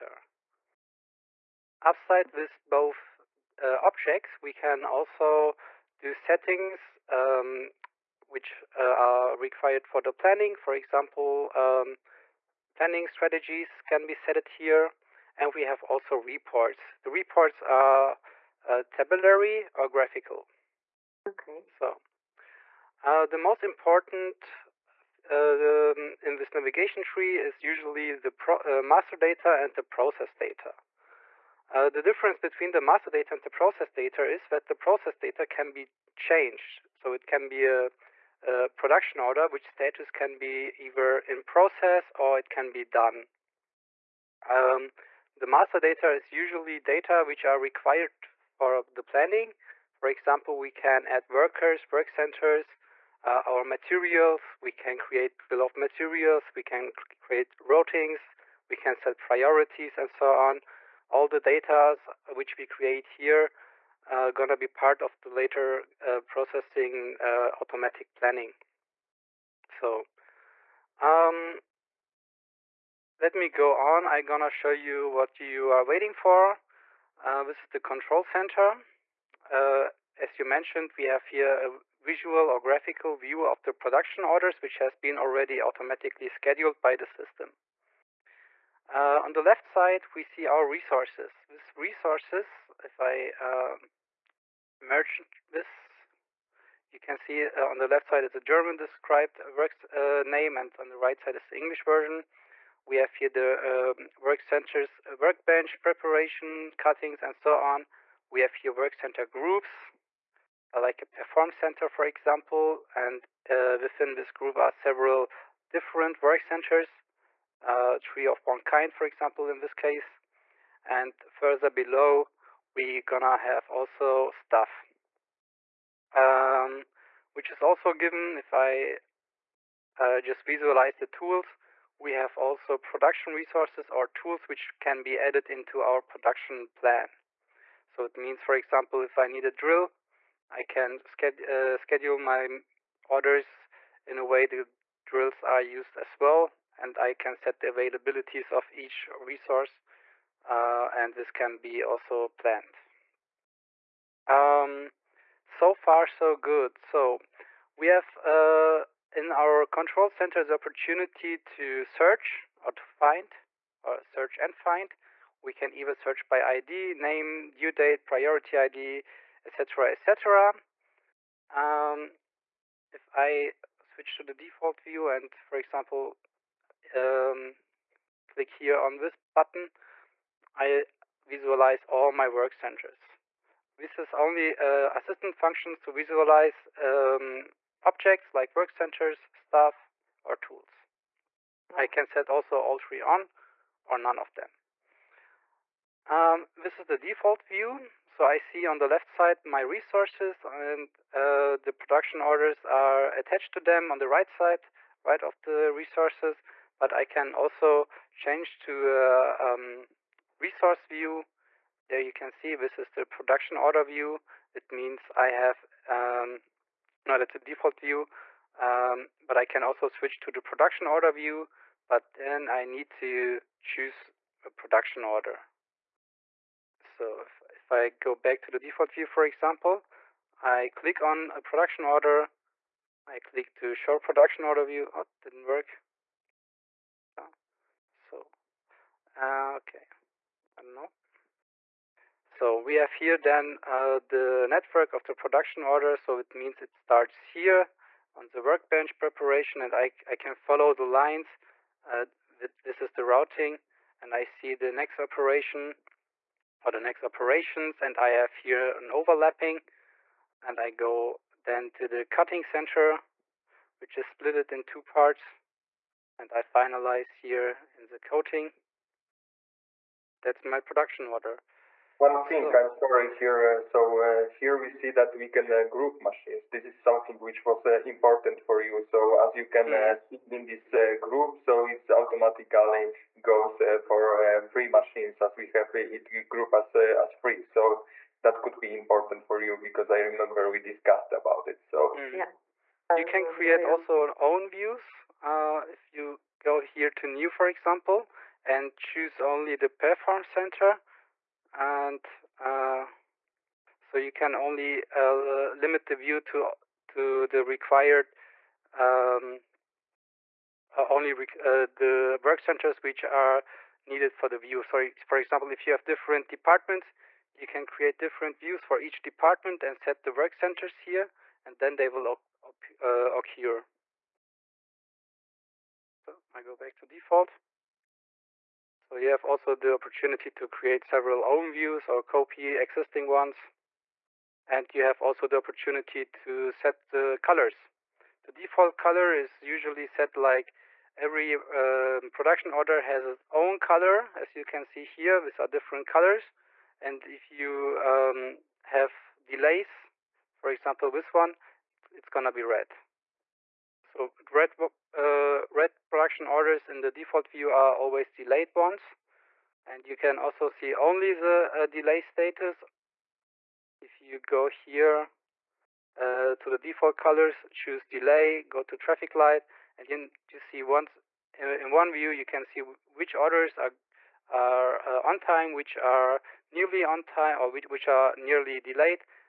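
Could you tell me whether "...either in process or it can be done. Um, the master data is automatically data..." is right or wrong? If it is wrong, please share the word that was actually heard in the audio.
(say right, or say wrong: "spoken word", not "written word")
wrong: "usually", not "automatically".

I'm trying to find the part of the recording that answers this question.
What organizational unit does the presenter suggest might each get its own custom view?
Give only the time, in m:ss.
5:16.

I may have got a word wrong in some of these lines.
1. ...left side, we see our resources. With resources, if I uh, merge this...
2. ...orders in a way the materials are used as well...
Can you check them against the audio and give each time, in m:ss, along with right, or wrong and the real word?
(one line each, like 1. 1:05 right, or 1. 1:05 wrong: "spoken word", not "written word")
1. 1:29 right
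2. 2:23 wrong: "drills", not "materials".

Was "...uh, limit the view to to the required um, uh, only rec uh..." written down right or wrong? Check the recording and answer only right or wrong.
right.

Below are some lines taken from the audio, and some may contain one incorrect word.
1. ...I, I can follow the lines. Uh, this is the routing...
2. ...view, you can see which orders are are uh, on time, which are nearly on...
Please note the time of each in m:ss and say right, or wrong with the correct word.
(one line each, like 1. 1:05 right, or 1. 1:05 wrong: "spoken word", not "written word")
1. 4:09 right
2. 6:11 right.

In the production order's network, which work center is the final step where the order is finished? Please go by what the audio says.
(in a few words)
Coating.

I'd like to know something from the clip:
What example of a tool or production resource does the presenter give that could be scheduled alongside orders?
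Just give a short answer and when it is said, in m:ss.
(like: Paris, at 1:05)
A drill, at 2:19.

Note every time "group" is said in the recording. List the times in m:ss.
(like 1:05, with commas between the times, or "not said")
1:49, 1:54, 4:35, 4:41, 4:46.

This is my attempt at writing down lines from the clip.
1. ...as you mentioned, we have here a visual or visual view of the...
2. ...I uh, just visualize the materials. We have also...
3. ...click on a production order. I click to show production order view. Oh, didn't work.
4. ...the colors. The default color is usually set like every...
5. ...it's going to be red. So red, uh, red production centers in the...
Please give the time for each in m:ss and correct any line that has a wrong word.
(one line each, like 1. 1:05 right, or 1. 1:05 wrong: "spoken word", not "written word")
1. 1:20 wrong: "graphical", not "visual"
2. 2:08 wrong: "tools", not "materials"
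3. 3:50 right
4. 5:36 right
5. 5:51 wrong: "orders", not "centers".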